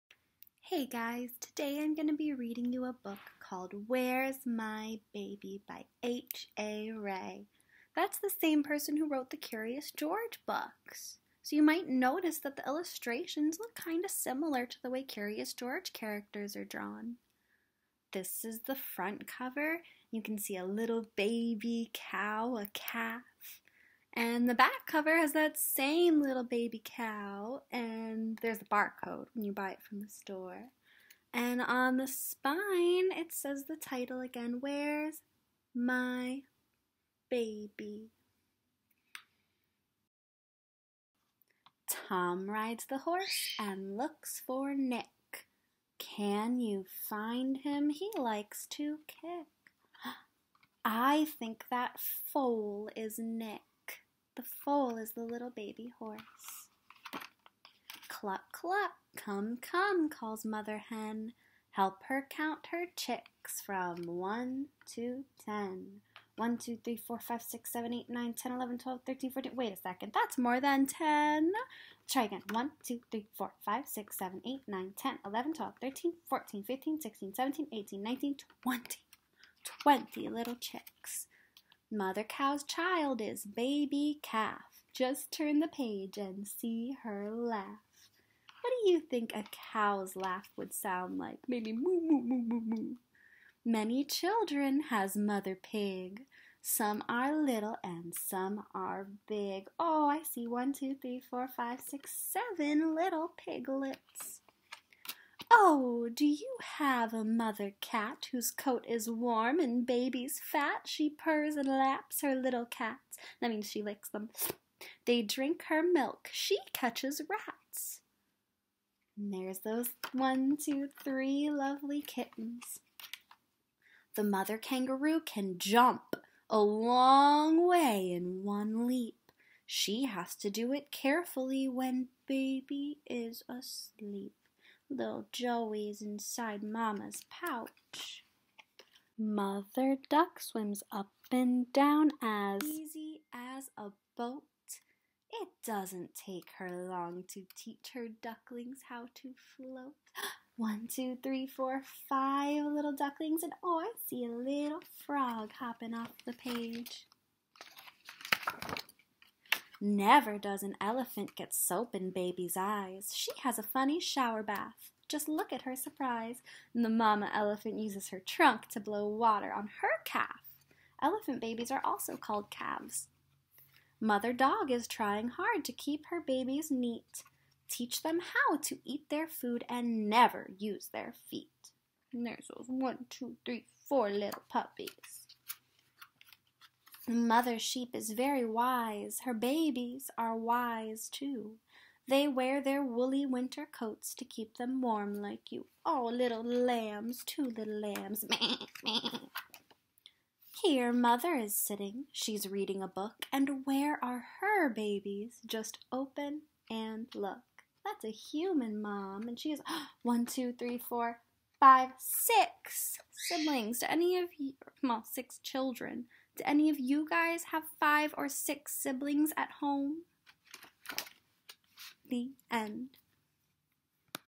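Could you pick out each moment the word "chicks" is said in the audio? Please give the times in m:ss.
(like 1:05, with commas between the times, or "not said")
1:02, 1:20.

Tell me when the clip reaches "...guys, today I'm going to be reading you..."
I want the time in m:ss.
0:00.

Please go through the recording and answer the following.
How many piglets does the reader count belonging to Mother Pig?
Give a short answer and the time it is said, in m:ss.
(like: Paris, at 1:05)
7, at 1:42.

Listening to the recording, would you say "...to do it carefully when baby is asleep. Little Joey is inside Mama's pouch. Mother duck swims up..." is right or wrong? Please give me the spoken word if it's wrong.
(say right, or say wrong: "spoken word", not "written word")
right.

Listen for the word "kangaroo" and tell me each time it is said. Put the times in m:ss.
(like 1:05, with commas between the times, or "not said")
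2:04.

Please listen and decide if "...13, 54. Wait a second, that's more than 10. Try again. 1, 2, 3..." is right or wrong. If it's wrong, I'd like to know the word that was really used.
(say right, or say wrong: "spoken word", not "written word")
wrong: "14", not "54".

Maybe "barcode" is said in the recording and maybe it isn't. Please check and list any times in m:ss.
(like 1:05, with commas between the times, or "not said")
0:28.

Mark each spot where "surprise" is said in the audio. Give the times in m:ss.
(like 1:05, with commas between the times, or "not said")
2:45.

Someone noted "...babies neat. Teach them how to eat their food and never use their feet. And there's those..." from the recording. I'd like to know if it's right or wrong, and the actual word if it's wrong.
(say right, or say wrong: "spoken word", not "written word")
right.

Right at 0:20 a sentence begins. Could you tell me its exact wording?
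You can see a little baby cow, a calf.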